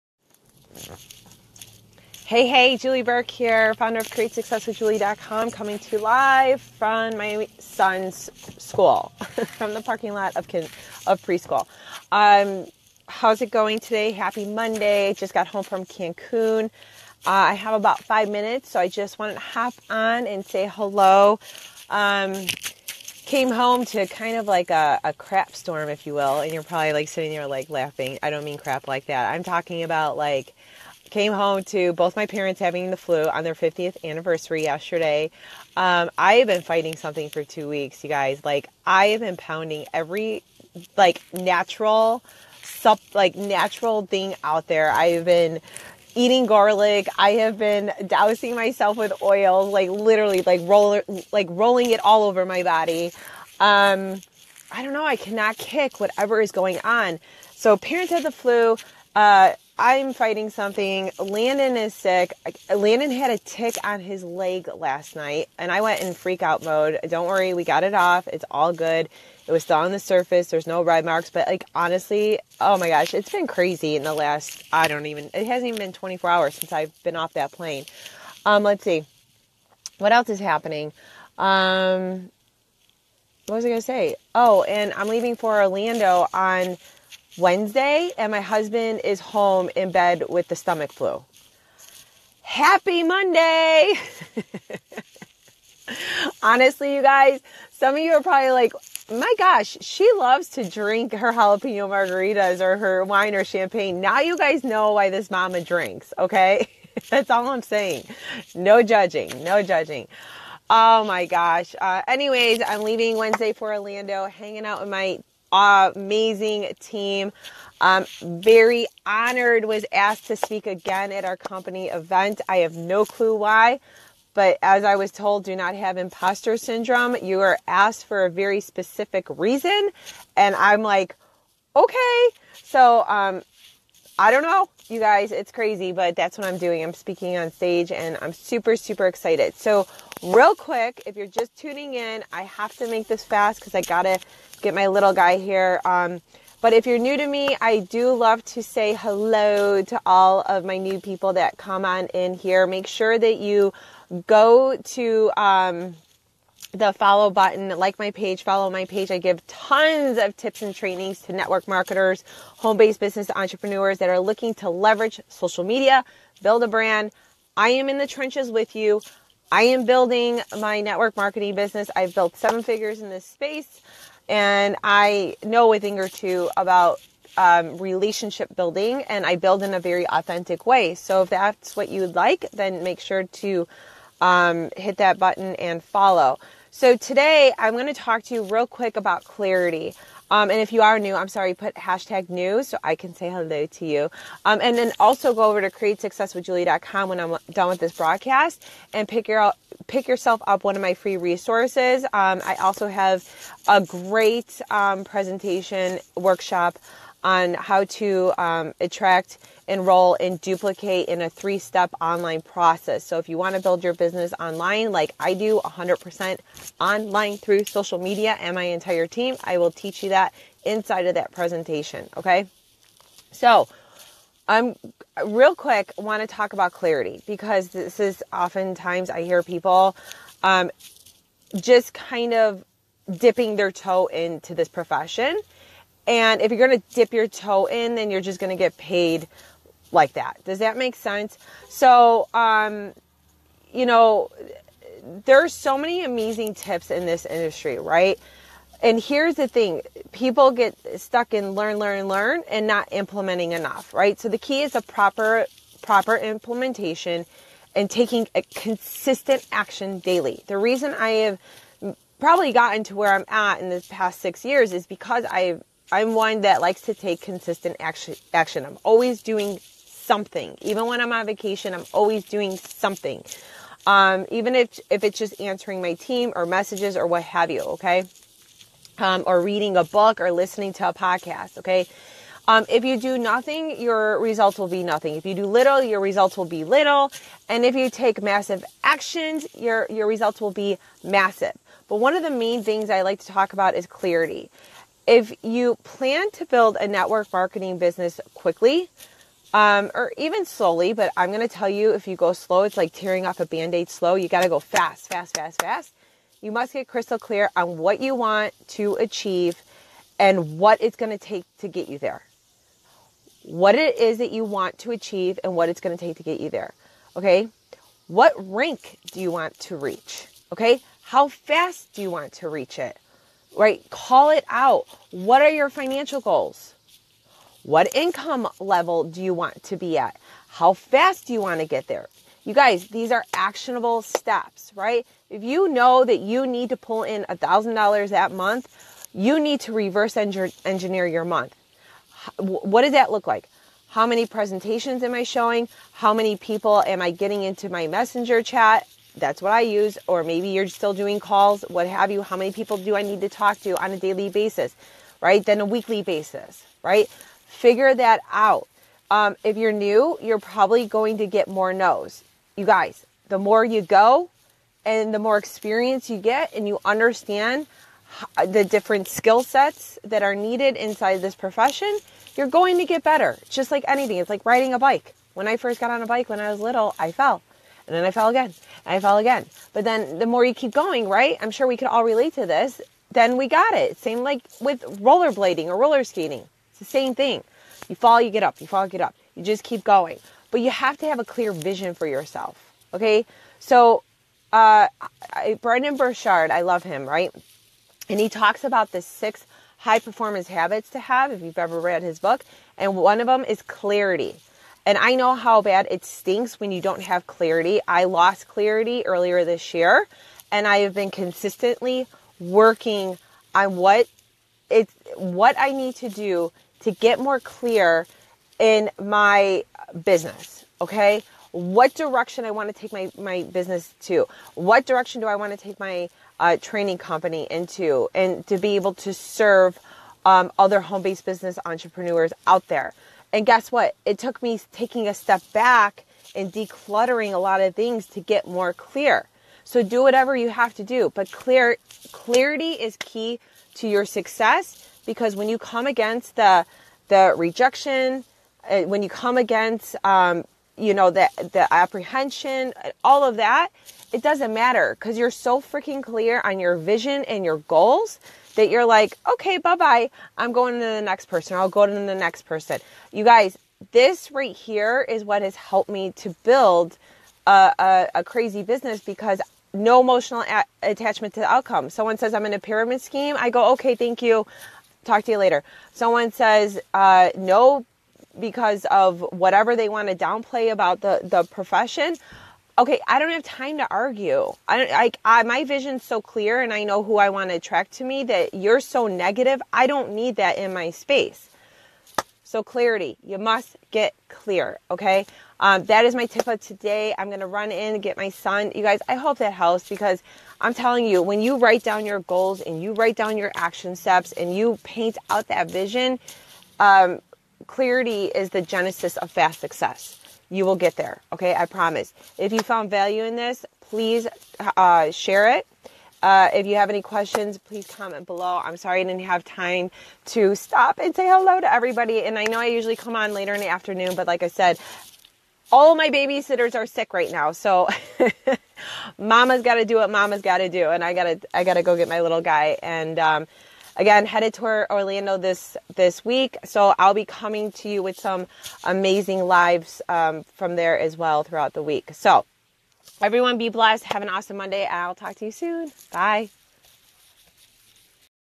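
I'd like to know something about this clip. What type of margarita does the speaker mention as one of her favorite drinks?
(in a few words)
Jalapeno.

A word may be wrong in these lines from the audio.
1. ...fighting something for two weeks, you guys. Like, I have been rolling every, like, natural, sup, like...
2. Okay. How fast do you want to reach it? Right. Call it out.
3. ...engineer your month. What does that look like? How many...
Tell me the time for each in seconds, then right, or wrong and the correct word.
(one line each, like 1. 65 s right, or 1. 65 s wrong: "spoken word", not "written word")
1. 36 s wrong: "pounding", not "rolling"
2. 320 s right
3. 340 s right.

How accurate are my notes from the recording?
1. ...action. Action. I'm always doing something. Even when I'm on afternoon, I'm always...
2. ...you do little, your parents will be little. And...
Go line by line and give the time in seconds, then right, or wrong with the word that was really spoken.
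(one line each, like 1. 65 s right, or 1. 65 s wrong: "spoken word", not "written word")
1. 267 s wrong: "vacation", not "afternoon"
2. 285 s wrong: "results", not "parents".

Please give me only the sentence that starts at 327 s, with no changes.
What income level do you want to be at?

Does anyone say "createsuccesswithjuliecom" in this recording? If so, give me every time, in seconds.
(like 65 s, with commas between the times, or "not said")
4 s, 195 s.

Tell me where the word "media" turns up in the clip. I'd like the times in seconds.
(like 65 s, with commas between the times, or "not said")
165 s, 217 s.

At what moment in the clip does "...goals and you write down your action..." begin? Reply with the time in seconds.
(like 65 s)
502 s.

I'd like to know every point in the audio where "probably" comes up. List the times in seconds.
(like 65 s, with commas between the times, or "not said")
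26 s, 98 s, 262 s, 360 s.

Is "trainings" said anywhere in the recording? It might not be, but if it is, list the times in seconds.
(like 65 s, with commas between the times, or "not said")
160 s, 426 s.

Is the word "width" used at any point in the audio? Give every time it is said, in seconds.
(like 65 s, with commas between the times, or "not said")
not said.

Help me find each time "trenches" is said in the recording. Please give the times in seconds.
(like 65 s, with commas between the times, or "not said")
168 s.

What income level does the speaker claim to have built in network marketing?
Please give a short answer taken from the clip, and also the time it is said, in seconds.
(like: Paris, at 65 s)
Seven figures, at 172 s.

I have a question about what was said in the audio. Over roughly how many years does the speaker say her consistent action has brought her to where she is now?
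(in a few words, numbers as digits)
6.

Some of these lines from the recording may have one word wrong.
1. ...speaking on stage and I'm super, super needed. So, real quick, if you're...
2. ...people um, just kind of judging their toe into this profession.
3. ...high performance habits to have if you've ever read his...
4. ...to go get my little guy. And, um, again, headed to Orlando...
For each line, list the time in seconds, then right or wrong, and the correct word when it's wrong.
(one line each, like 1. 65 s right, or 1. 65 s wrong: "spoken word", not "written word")
1. 136 s wrong: "excited", not "needed"
2. 229 s wrong: "dipping", not "judging"
3. 399 s right
4. 531 s right.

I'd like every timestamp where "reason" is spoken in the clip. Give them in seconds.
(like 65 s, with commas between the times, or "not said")
129 s, 260 s.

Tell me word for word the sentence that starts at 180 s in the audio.
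So if that's what you'd like, then make sure to um, hit that button and follow.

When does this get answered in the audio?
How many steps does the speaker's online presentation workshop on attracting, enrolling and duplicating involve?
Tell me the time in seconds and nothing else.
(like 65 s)
211 s.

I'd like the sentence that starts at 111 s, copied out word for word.
Uh, anyways, I'm leaving Wednesday for Orlando, hanging out with my amazing team.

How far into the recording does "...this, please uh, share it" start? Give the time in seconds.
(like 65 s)
513 s.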